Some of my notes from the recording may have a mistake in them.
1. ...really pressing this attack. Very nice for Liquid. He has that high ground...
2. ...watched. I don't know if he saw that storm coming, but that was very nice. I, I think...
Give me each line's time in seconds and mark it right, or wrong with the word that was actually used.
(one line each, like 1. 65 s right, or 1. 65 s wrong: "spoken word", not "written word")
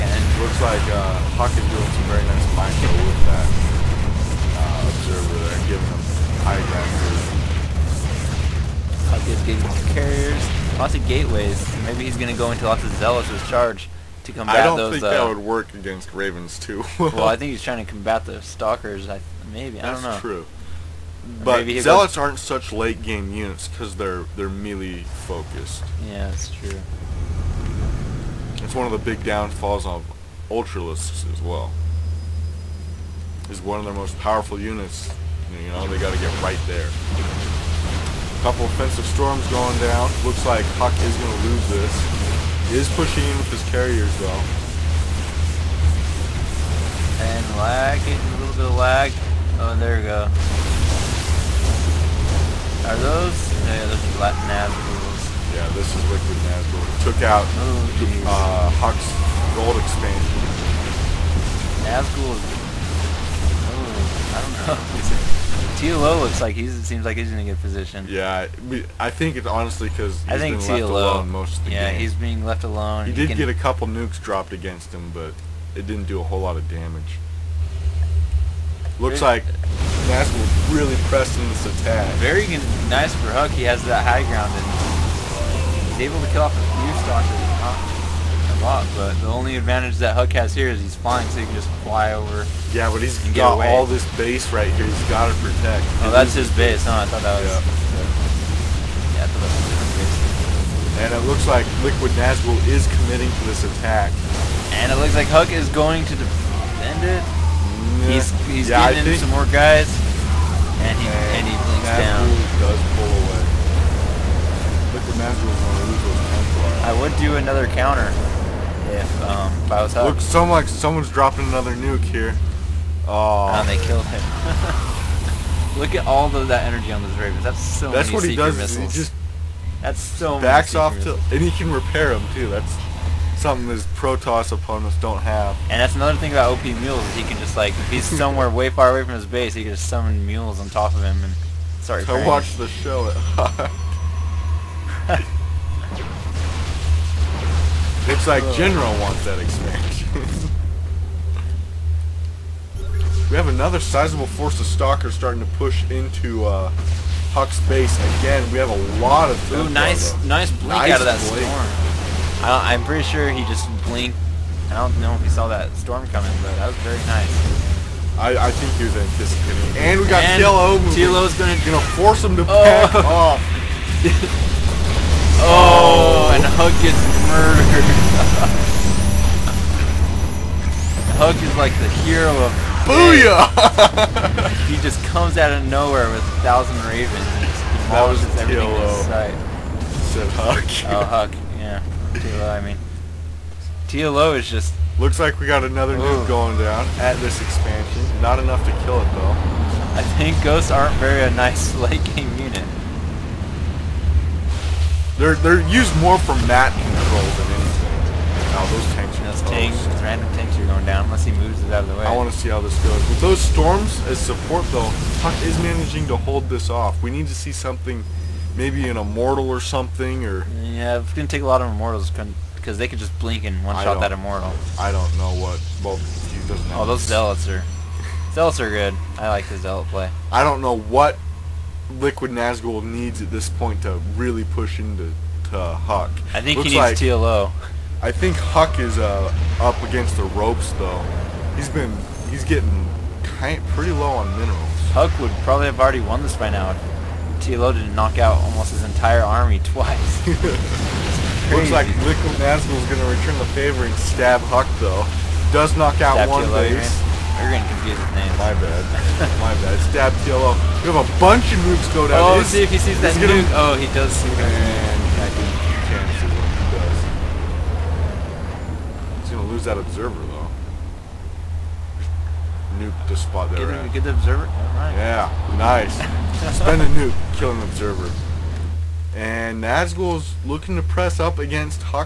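1. 80 s wrong: "Huck", not "Liquid"
2. 163 s wrong: "blinked", not "watched".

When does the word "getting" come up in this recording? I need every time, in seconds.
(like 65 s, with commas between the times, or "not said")
9 s, 108 s, 242 s.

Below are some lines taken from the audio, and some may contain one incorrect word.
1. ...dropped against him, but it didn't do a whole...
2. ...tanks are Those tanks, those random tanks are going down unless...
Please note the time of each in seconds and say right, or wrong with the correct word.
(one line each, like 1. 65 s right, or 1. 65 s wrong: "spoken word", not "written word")
1. 74 s right
2. 208 s right.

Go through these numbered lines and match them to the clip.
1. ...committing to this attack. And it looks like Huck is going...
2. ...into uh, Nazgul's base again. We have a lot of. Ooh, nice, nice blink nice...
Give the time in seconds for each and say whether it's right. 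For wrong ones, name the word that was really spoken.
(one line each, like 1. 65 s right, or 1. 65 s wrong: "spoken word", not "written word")
1. 103 s right
2. 155 s wrong: "Huck", not "Nazgul".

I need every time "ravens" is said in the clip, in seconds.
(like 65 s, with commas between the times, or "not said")
16 s, 127 s, 186 s.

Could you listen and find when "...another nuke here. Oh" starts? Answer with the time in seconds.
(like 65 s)
121 s.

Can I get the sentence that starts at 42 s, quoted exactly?
He is pushing in with his carriers, though.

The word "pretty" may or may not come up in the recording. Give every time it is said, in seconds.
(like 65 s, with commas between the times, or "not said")
162 s, 243 s.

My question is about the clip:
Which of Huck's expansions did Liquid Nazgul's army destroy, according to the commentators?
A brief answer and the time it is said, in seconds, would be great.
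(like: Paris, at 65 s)
Gold expansion, at 59 s.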